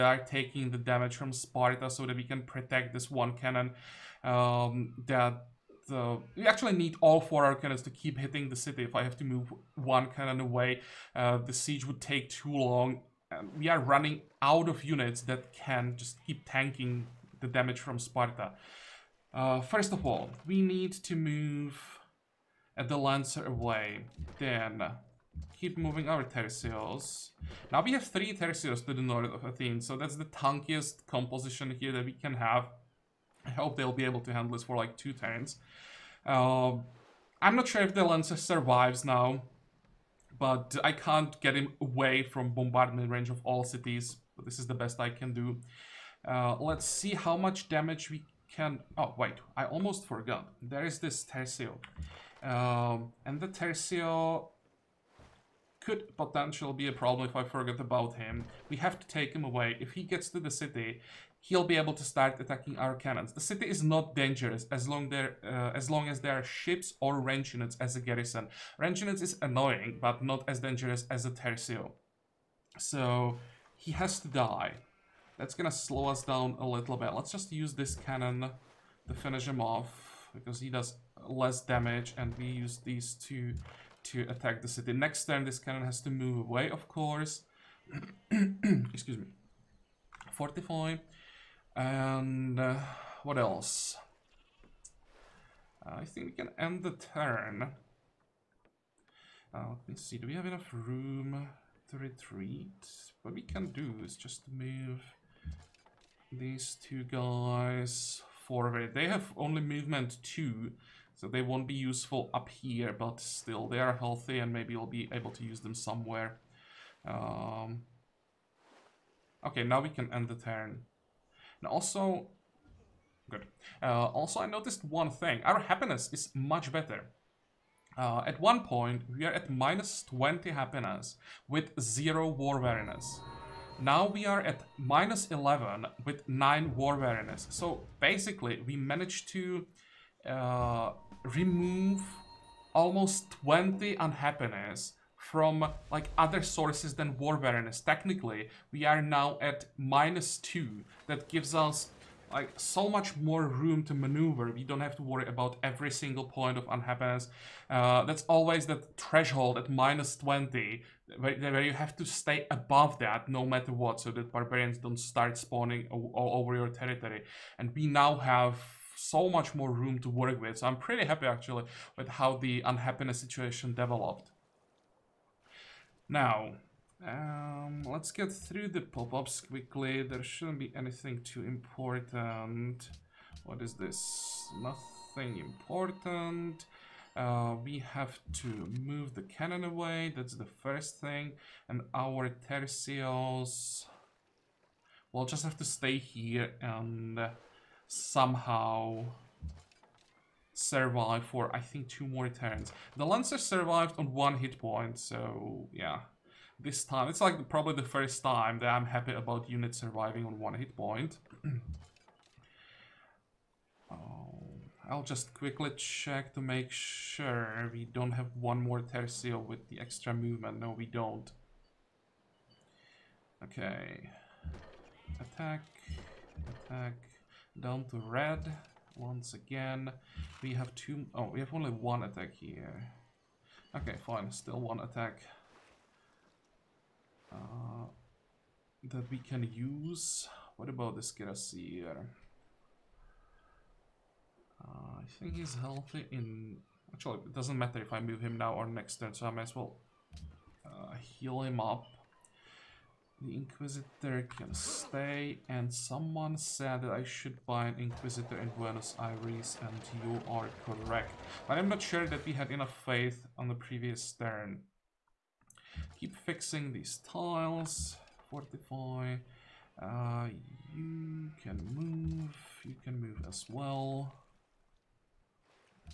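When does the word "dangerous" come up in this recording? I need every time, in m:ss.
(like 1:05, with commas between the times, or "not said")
1:04, 1:10.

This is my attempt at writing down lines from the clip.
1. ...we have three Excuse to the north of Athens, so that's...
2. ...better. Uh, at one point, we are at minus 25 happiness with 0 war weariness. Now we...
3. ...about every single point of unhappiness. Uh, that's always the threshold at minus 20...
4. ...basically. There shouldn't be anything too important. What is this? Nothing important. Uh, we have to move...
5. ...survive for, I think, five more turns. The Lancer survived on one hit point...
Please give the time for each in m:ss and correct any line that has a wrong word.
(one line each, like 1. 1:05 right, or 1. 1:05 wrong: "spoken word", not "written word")
1. 0:27 wrong: "Tercios", not "Excuse"
2. 2:06 wrong: "20", not "25"
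3. 2:35 right
4. 2:59 wrong: "quickly", not "basically"
5. 3:20 wrong: "two", not "five".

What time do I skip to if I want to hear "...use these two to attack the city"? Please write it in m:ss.
1:22.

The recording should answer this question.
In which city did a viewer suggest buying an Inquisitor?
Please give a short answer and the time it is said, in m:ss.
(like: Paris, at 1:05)
Buenos Aires, at 4:18.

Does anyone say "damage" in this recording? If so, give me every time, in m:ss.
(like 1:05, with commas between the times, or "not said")
0:00, 0:17, 0:47, 1:21.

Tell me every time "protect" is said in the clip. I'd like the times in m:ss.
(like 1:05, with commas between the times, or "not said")
0:02.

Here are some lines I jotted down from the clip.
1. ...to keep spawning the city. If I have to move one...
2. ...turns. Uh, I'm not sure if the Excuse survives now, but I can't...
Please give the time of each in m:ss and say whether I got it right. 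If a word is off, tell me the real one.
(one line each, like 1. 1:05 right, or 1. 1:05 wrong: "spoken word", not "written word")
1. 0:07 wrong: "hitting", not "spawning"
2. 0:35 wrong: "Lancer", not "Excuse".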